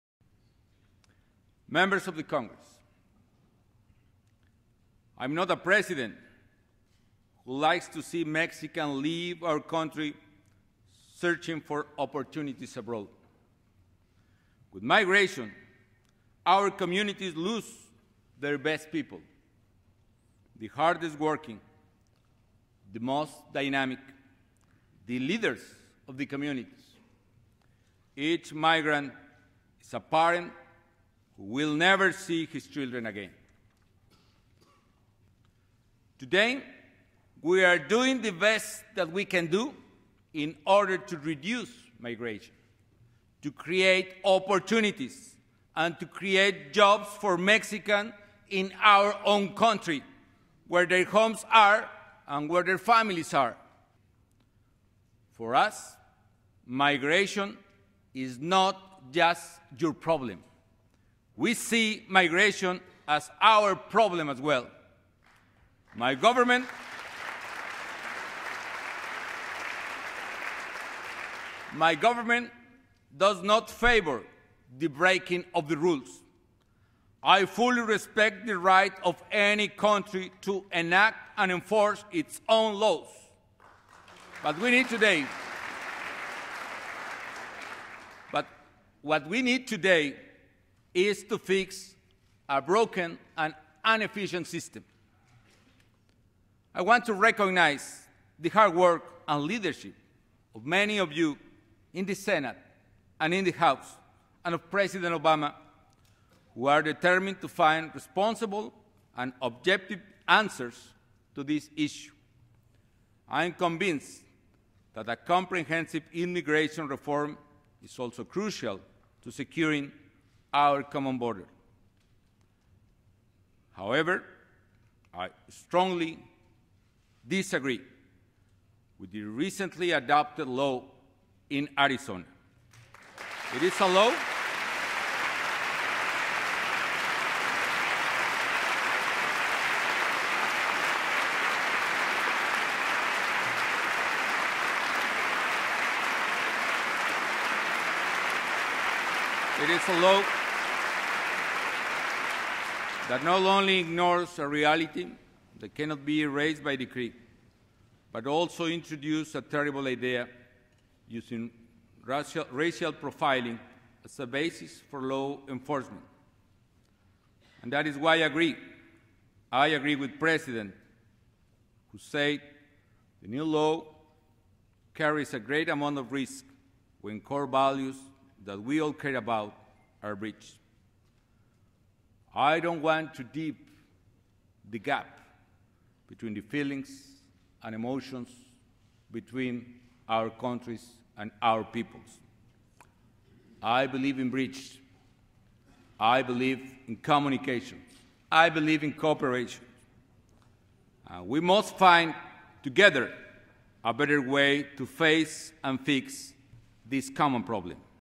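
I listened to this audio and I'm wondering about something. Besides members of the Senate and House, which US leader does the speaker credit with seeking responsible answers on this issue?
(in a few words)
President Obama.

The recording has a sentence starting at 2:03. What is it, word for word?
However, I strongly disagree with the recently adopted law in Arizona.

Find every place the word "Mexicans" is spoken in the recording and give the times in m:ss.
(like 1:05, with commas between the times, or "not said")
0:08, 0:47.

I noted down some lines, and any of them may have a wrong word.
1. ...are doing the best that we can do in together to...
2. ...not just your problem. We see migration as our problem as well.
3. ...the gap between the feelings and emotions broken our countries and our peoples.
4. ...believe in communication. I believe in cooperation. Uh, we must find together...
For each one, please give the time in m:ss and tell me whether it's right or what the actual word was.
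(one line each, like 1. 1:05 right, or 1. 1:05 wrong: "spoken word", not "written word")
1. 0:37 wrong: "order", not "together"
2. 0:58 right
3. 3:04 wrong: "between", not "broken"
4. 3:16 right.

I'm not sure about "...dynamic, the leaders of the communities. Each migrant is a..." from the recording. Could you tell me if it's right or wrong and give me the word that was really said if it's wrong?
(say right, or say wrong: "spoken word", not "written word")
right.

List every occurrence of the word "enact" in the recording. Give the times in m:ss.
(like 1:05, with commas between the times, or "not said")
1:20.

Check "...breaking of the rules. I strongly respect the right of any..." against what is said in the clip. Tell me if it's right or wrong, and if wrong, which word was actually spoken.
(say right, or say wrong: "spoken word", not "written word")
wrong: "fully", not "strongly".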